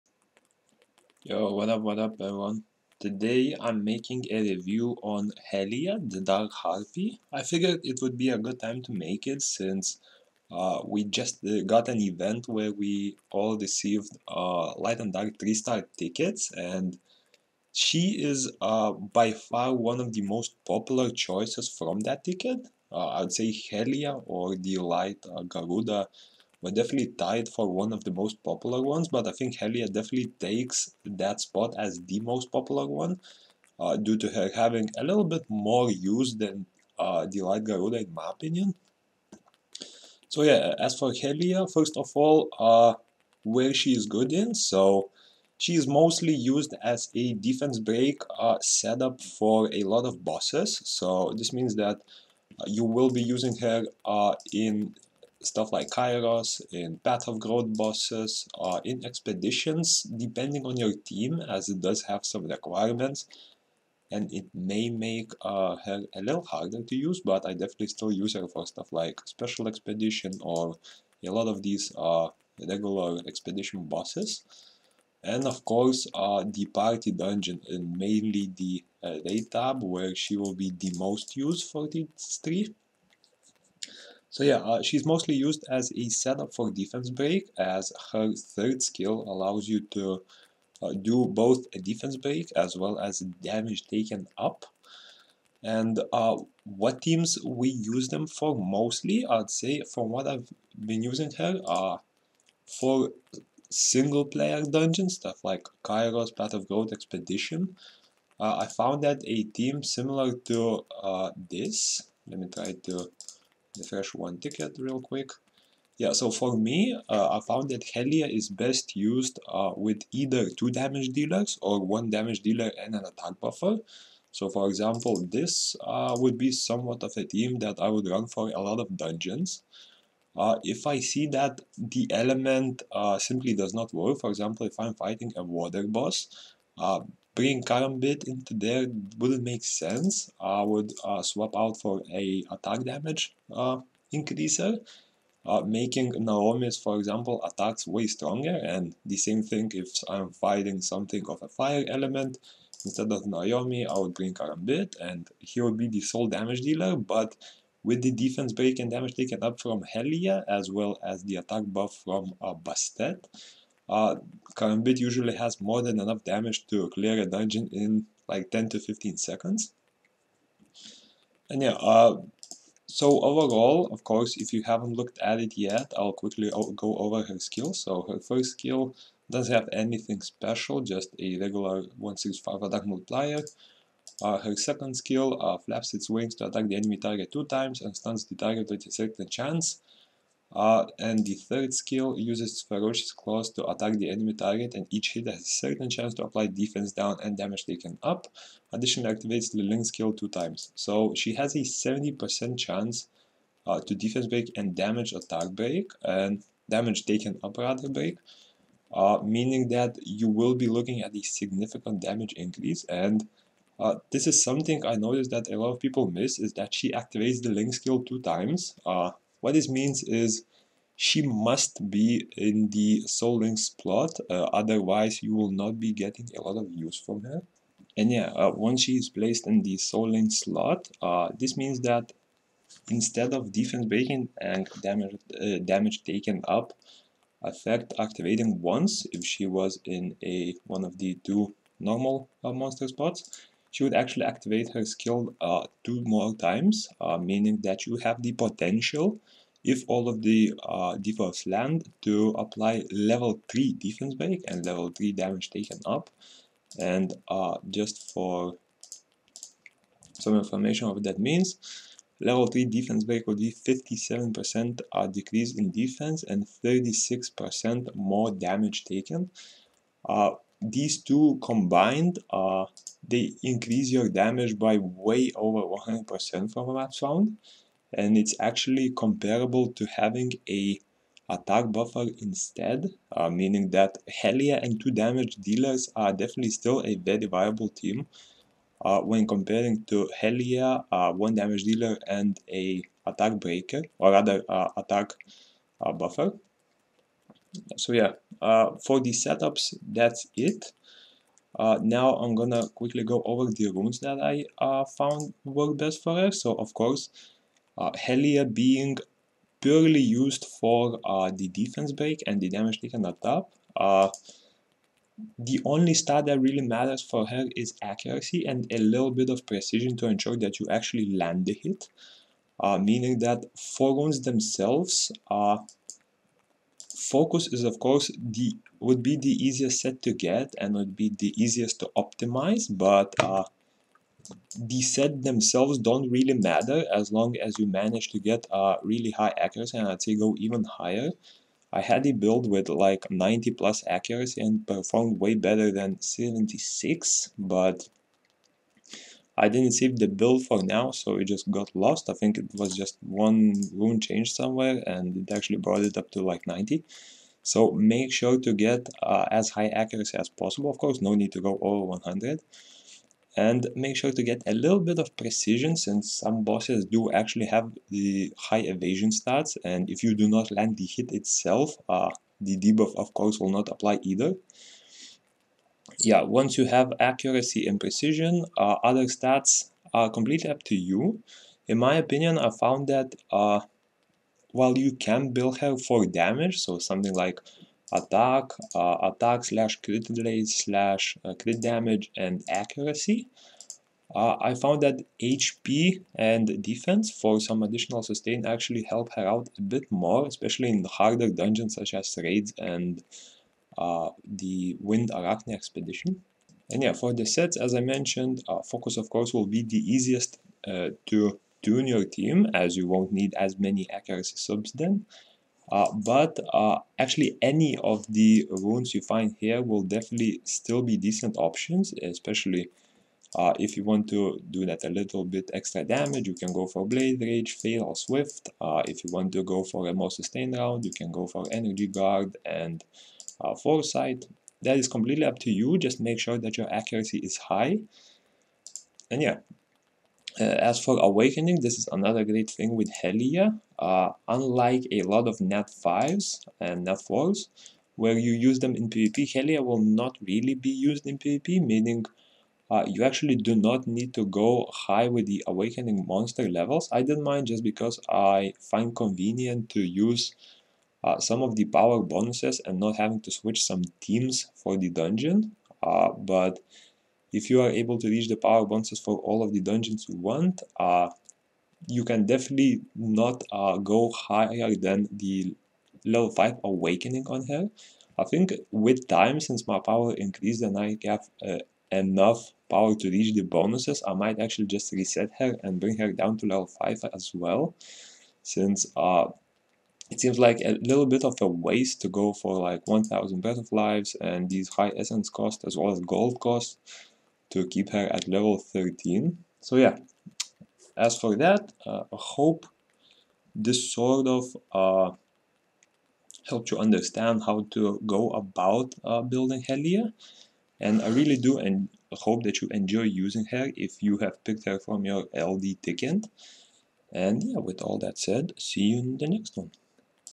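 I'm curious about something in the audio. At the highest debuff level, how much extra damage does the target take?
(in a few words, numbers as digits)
36%.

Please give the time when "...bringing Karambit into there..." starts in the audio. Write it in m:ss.
2:17.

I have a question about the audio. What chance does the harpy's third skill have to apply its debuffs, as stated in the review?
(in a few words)
70%.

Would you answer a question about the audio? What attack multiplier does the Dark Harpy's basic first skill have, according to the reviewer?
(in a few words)
165.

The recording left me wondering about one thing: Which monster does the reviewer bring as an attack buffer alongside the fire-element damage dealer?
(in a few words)
Bastet.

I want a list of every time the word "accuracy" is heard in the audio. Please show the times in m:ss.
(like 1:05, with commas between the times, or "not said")
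5:17, 5:39, 5:43, 5:59, 6:16, 6:32, 6:53, 7:16.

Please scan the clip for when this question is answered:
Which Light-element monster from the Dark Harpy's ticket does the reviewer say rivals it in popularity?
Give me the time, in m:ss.
0:24.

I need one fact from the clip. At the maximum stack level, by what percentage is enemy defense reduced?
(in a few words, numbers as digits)
57%.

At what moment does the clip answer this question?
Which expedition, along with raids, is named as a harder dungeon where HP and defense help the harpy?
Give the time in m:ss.
6:44.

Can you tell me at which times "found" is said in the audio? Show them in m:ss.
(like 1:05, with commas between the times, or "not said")
1:48, 1:57, 5:04, 6:22, 6:34.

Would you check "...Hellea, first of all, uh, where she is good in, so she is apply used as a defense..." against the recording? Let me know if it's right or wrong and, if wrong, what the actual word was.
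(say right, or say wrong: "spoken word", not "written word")
wrong: "mostly", not "apply".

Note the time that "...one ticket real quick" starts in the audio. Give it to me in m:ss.
1:54.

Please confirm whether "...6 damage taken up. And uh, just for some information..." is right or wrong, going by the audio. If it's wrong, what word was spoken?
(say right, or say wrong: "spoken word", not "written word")
wrong: "3", not "6".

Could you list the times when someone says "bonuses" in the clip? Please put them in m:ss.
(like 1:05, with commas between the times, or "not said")
7:42, 7:48, 8:03.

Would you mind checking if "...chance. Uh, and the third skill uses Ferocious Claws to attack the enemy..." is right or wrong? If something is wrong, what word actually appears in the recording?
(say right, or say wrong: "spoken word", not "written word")
right.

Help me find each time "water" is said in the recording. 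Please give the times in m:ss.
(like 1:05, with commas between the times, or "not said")
2:15.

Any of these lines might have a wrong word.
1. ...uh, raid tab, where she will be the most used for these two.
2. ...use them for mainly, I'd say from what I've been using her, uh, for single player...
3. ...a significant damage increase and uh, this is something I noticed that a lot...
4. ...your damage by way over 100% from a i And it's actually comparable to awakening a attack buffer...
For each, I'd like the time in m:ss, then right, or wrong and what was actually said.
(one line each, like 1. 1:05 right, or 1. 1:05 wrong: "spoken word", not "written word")
1. 1:19 wrong: "three", not "two"
2. 1:37 wrong: "mostly", not "mainly"
3. 3:31 right
4. 4:33 wrong: "having", not "awakening".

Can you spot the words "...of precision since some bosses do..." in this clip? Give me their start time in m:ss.
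6:04.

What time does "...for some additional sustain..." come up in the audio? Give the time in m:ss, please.
6:37.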